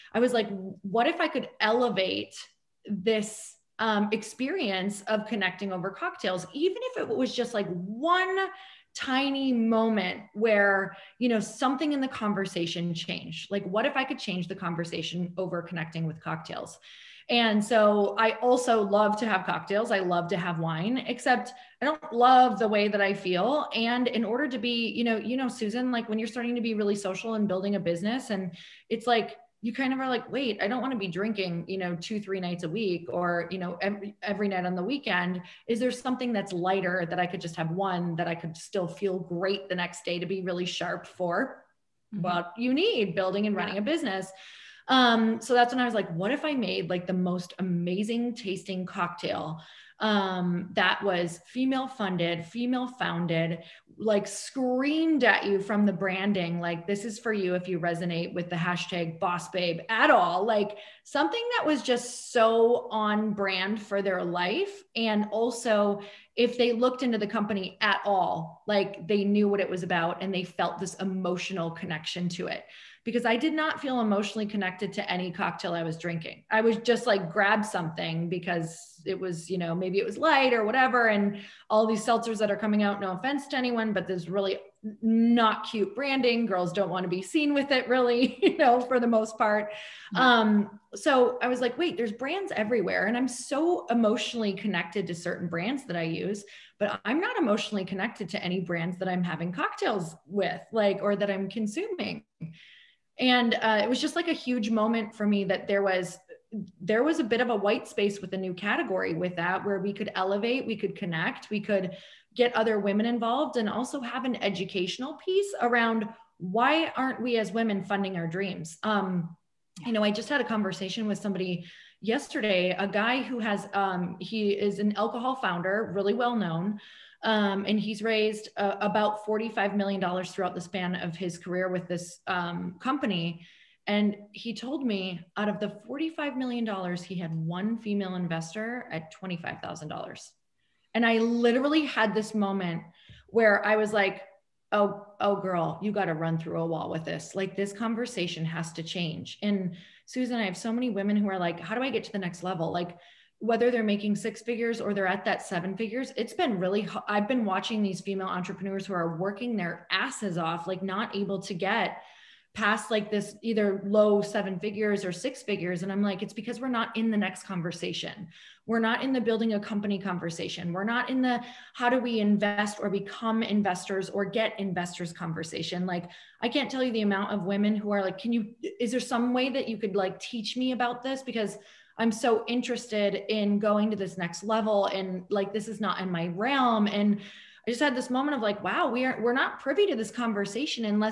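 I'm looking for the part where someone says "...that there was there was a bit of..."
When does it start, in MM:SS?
01:45.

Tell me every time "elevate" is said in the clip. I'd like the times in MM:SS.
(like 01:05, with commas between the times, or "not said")
00:01, 01:50.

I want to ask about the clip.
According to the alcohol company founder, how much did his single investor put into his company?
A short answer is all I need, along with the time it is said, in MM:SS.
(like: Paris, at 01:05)
$25,000, at 02:19.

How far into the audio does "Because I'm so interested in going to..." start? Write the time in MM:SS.
03:01.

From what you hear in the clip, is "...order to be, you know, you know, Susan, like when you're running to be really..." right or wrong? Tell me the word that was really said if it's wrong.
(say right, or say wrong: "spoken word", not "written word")
wrong: "starting", not "running".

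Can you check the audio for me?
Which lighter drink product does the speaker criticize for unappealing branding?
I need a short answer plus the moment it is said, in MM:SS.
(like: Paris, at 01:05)
seltzers, at 01:22.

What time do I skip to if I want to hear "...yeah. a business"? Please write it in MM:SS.
00:43.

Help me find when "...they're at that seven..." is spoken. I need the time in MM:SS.
02:34.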